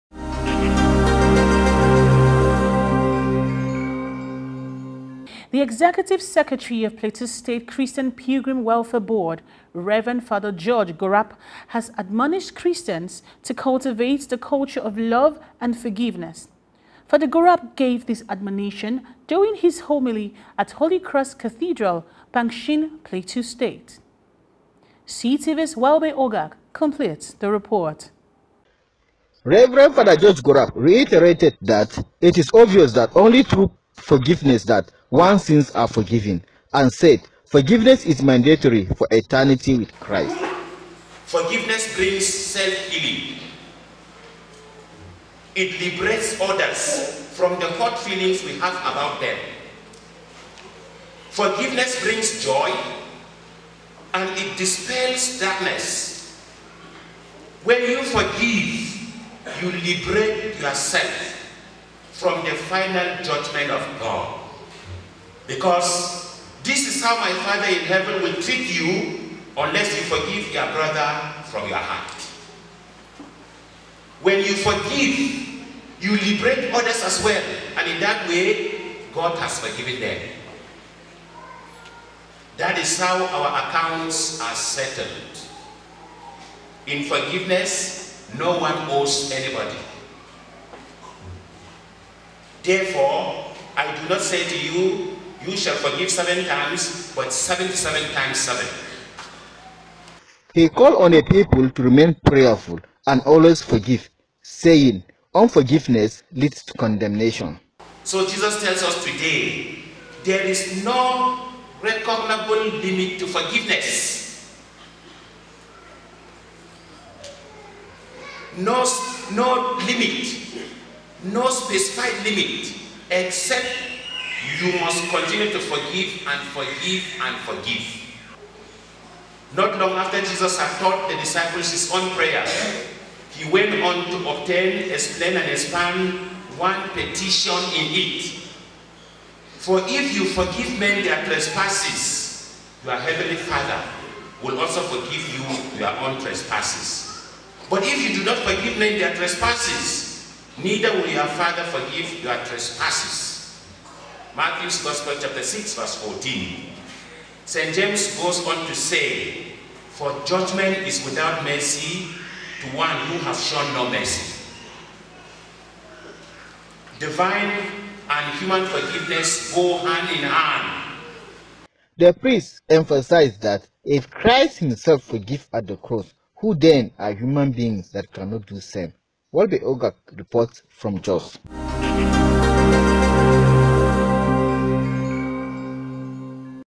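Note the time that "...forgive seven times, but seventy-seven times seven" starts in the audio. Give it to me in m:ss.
1:35.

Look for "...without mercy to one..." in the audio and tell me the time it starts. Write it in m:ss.
2:41.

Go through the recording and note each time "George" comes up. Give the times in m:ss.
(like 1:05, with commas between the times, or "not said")
0:10, 0:30.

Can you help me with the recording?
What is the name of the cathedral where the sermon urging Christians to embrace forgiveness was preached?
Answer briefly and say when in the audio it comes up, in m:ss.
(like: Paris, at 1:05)
Holy Cross Cathedral, at 0:20.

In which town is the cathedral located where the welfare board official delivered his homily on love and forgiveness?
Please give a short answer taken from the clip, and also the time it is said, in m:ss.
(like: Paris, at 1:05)
Pankshin, at 0:22.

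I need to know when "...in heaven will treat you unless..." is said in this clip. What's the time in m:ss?
1:07.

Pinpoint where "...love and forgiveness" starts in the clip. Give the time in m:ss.
0:14.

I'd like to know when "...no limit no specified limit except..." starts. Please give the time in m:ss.
1:59.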